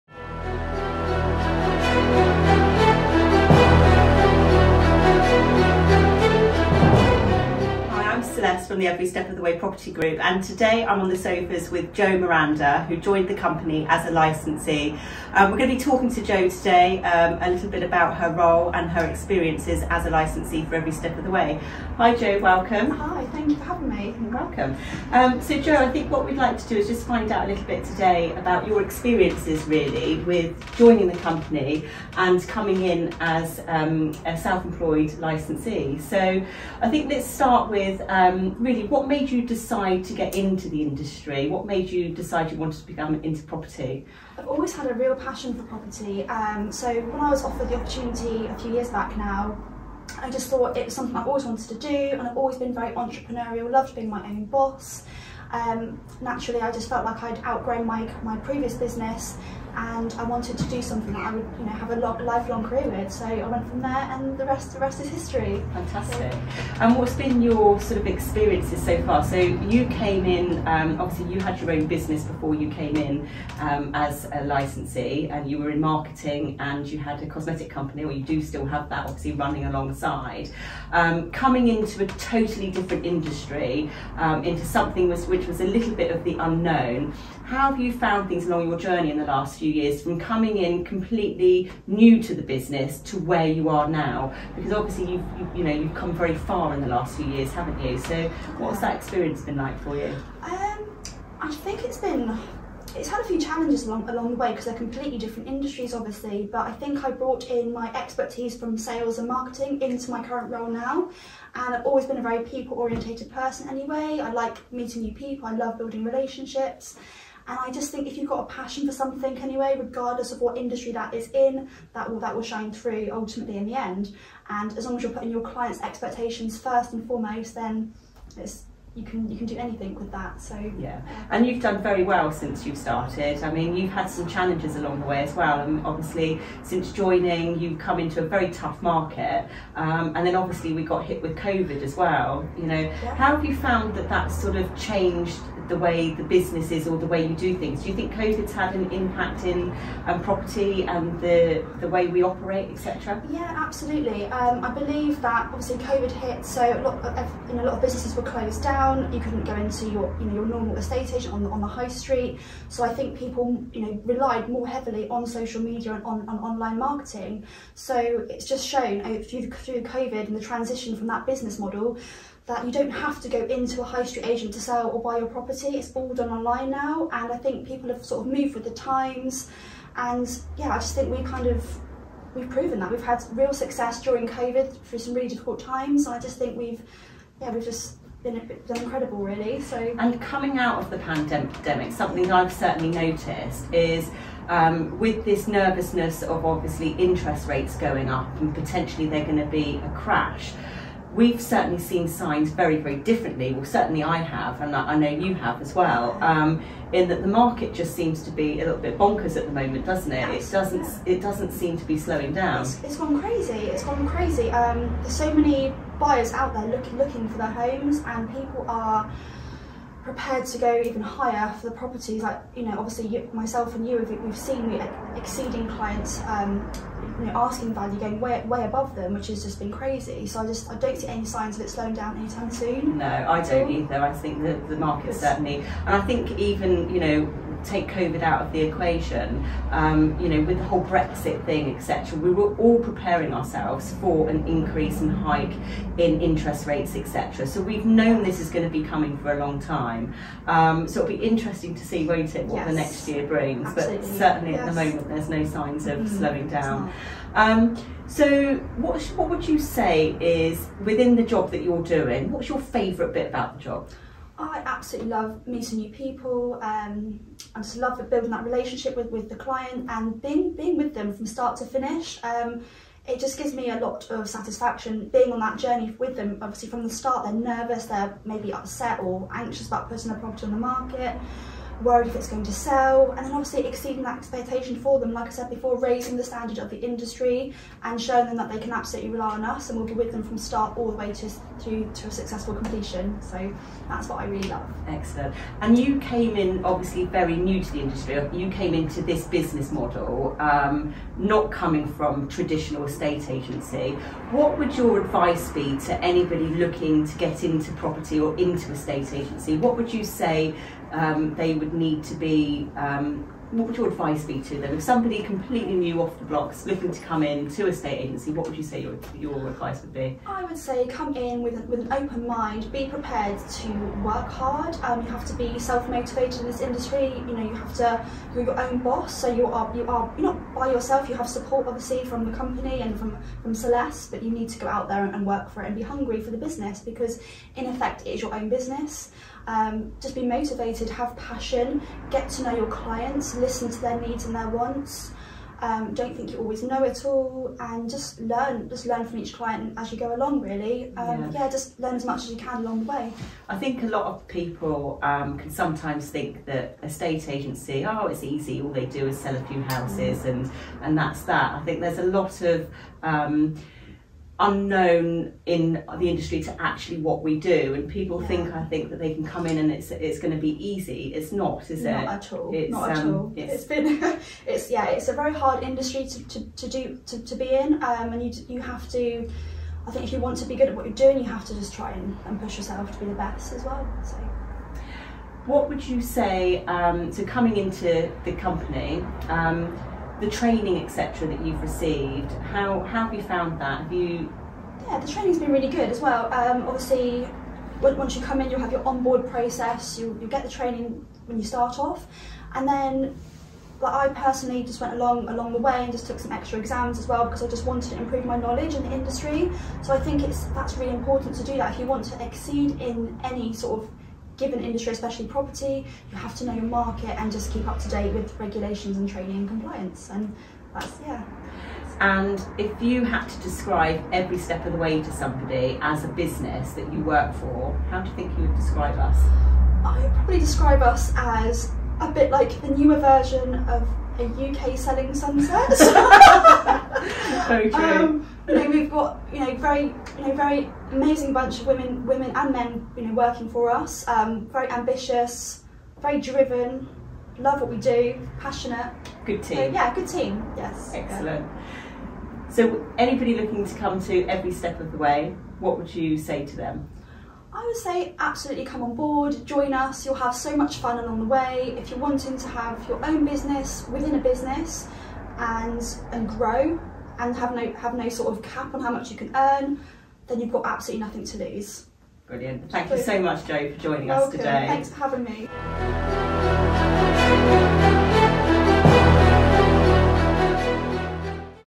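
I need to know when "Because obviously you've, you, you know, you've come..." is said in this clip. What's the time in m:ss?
1:34.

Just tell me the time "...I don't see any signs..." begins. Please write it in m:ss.
3:50.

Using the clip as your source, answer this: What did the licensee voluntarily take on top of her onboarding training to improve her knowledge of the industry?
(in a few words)
Extra exams.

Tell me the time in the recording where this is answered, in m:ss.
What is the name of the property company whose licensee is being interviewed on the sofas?
0:08.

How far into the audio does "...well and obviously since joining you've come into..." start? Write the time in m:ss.
2:15.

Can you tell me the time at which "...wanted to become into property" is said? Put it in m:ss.
0:42.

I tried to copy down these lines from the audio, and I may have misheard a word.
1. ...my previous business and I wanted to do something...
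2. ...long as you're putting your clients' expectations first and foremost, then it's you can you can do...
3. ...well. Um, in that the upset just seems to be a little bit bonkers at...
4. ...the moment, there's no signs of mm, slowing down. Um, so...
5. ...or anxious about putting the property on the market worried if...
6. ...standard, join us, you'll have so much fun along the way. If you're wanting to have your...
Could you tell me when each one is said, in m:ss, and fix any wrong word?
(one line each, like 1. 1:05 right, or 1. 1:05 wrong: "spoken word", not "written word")
1. 0:58 right
2. 2:04 right
3. 3:25 wrong: "market", not "upset"
4. 4:14 right
5. 4:38 right
6. 7:38 wrong: "board", not "standard".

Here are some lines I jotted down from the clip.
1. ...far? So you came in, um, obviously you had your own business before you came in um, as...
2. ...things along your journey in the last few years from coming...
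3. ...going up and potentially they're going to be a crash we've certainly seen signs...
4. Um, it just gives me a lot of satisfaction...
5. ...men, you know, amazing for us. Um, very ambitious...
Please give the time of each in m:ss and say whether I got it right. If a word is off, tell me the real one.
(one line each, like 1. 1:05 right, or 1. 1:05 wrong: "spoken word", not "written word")
1. 1:09 right
2. 1:28 right
3. 3:17 right
4. 4:32 right
5. 7:22 wrong: "working", not "amazing".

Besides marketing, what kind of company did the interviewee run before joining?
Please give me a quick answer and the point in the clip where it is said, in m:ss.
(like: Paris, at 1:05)
Cosmetic company, at 1:17.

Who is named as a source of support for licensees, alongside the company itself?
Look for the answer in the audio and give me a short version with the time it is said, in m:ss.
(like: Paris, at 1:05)
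Celeste, at 5:33.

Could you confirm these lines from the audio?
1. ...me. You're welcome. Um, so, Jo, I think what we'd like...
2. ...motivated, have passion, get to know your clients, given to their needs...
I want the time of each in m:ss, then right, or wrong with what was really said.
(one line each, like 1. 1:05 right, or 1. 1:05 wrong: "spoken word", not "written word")
1. 0:23 right
2. 5:40 wrong: "listen", not "given".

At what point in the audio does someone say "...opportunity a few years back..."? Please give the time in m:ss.
0:47.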